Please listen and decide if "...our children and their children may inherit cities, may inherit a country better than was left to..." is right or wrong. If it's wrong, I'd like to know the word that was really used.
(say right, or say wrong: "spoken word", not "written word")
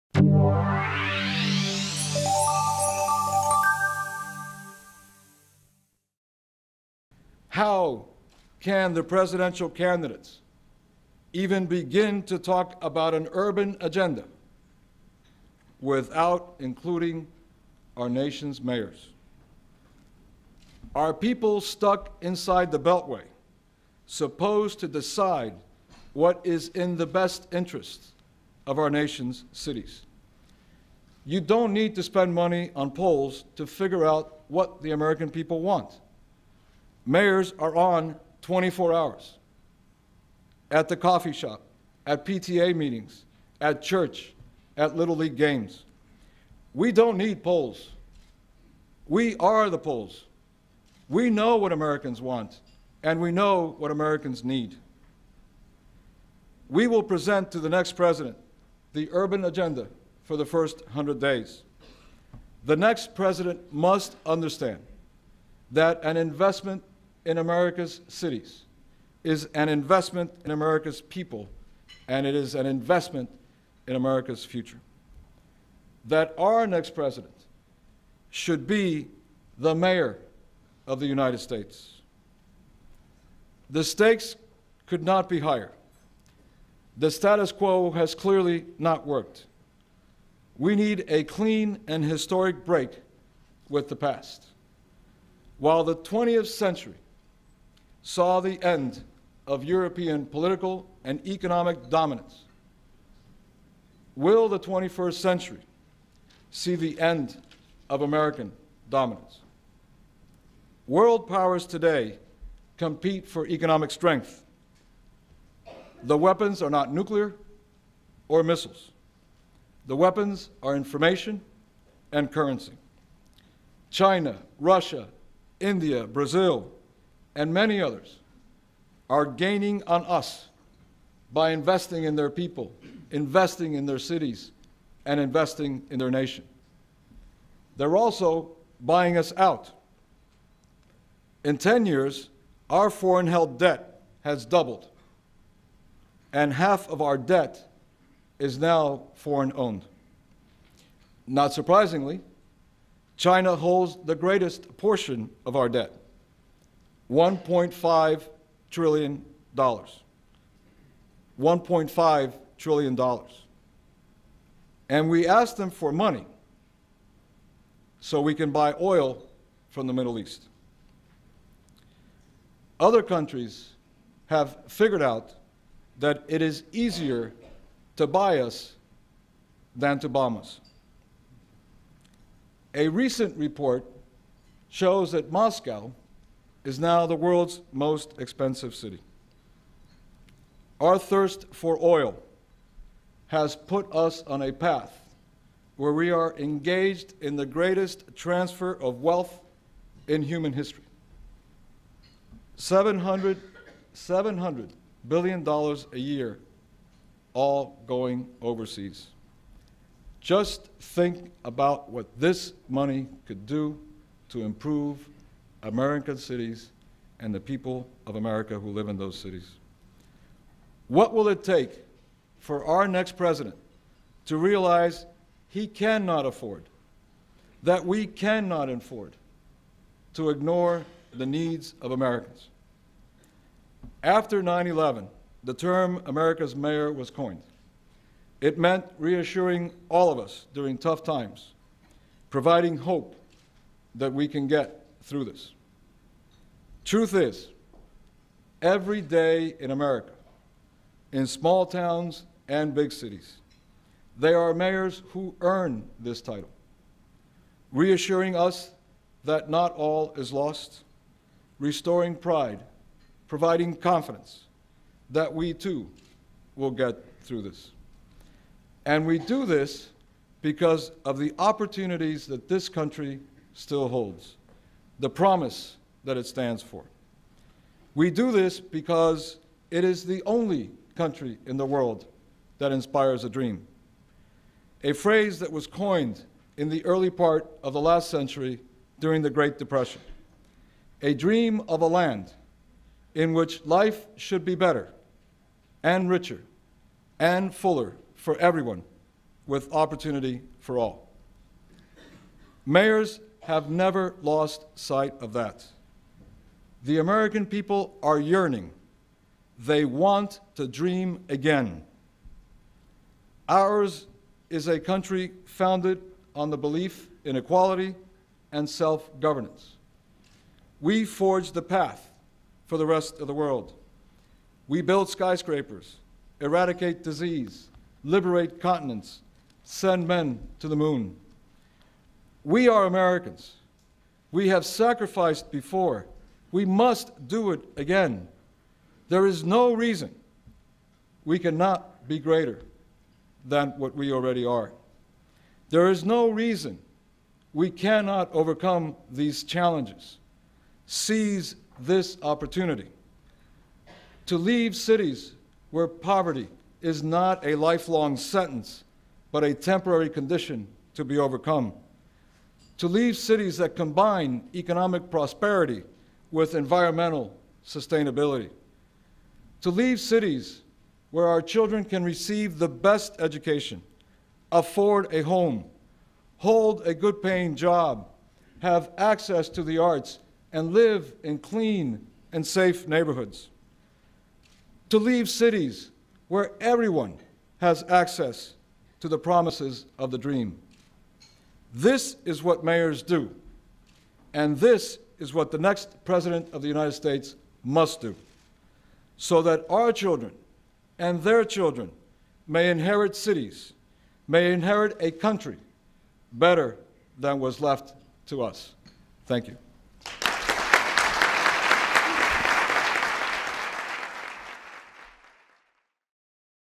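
right.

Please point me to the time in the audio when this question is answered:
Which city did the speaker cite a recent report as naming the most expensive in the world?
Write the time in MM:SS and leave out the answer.
03:05.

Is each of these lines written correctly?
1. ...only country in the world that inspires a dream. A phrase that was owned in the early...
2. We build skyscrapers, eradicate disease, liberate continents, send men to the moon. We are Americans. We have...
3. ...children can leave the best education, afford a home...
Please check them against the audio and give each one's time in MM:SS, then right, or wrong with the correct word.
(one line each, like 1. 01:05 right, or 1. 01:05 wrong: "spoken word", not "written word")
1. 04:40 wrong: "coined", not "owned"
2. 05:24 right
3. 06:11 wrong: "receive", not "leave".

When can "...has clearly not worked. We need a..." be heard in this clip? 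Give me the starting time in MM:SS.
01:27.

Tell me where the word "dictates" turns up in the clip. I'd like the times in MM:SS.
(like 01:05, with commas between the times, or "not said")
not said.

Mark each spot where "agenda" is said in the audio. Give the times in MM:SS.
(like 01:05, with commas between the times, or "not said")
00:13, 00:59.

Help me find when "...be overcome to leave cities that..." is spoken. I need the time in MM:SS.
06:01.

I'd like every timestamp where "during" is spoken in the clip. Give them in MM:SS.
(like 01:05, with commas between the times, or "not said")
04:00, 04:48.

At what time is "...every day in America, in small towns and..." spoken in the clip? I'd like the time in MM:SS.
04:08.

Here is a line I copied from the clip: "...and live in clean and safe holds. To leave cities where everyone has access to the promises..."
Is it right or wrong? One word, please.
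wrong.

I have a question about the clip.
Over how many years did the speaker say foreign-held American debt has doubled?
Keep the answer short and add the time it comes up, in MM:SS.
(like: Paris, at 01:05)
10 years, at 02:21.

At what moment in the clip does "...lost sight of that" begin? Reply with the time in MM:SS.
05:04.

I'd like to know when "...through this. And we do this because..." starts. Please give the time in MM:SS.
04:27.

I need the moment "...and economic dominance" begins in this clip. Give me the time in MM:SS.
01:41.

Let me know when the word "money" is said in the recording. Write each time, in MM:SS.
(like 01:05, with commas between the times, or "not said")
00:32, 02:45, 03:32.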